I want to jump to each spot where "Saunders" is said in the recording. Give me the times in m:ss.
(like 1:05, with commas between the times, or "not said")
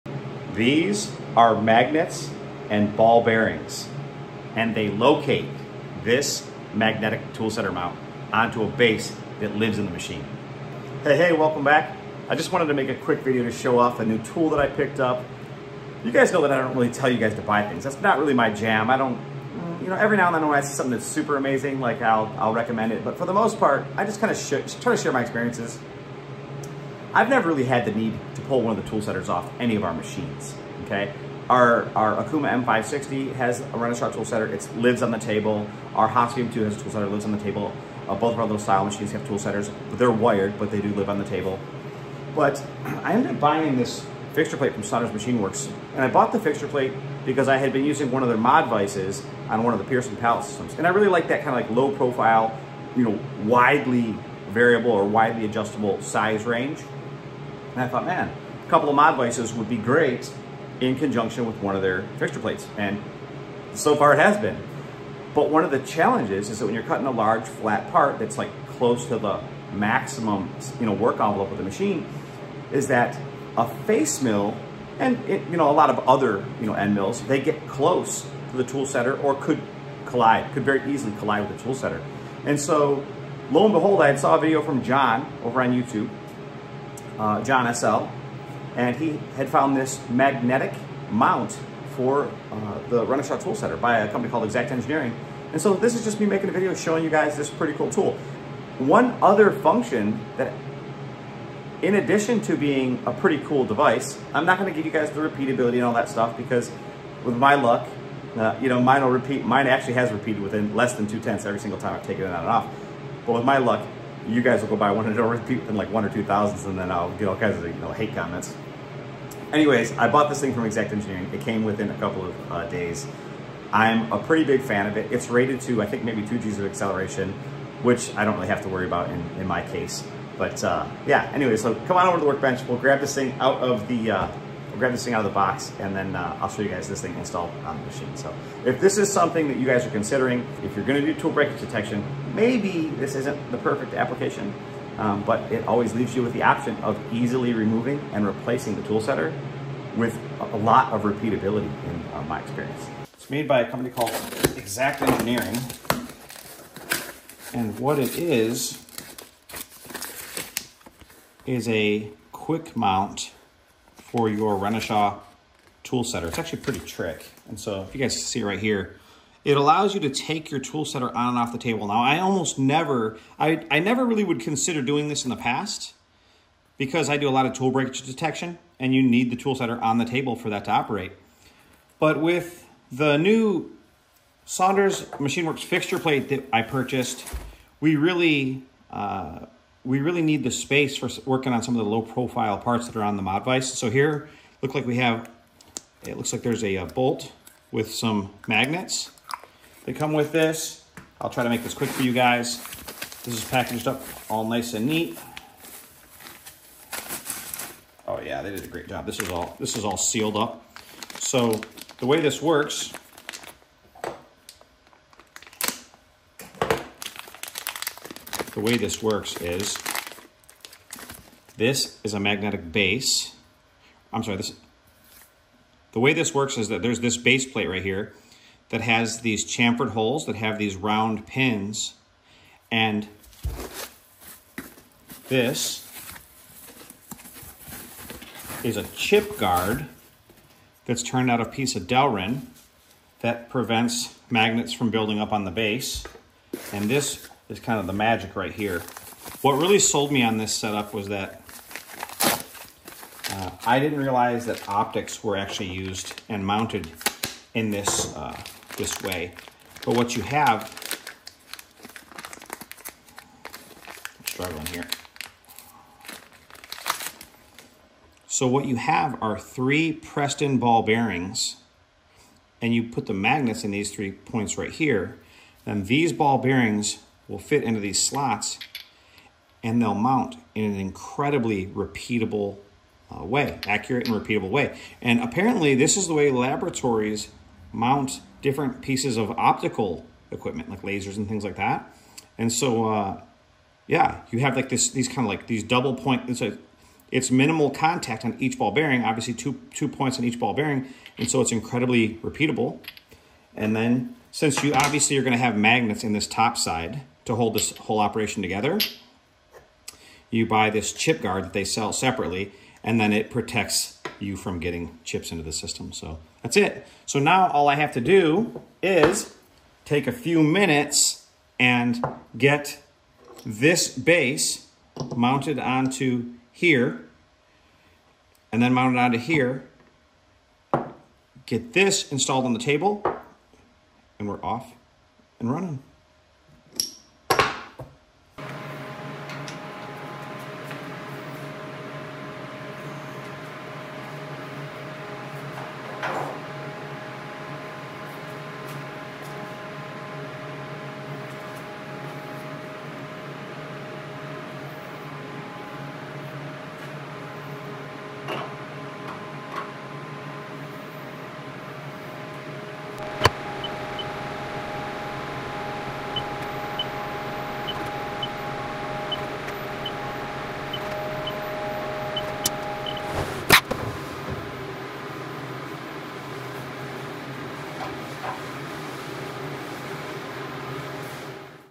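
0:44, 3:04.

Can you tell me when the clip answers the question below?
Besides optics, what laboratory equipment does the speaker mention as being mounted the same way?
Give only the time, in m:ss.
4:50.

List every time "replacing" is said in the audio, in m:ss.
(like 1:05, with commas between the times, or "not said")
2:28.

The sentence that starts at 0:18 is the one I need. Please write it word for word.
I don't, you know, every now and then when I see something that's super amazing, like I'll, I'll recommend it.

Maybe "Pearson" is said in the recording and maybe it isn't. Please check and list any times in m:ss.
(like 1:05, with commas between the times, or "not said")
0:49.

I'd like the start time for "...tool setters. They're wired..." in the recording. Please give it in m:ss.
0:39.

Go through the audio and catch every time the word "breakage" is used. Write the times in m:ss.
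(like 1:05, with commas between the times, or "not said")
2:21, 2:57.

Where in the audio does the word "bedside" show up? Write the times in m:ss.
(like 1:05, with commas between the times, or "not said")
not said.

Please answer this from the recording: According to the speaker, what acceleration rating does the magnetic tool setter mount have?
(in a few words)
2 G's.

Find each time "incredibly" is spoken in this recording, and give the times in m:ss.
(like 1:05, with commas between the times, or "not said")
4:40, 5:01.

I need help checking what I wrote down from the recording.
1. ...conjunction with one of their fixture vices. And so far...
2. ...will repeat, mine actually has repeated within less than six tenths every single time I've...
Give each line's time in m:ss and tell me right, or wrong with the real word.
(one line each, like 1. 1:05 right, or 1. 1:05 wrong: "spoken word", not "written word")
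1. 1:00 wrong: "plates", not "vices"
2. 1:49 wrong: "two", not "six".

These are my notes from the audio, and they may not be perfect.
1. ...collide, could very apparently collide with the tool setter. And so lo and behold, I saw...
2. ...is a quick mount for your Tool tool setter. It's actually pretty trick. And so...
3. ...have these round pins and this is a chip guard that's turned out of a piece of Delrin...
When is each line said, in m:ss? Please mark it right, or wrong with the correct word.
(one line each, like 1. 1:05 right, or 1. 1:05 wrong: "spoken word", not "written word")
1. 1:20 wrong: "easily", not "apparently"
2. 2:41 wrong: "Renishaw", not "Tool"
3. 3:50 right.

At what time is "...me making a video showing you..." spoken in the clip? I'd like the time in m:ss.
1:36.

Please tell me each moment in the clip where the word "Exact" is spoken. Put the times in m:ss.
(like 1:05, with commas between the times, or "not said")
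1:34, 2:00, 2:34.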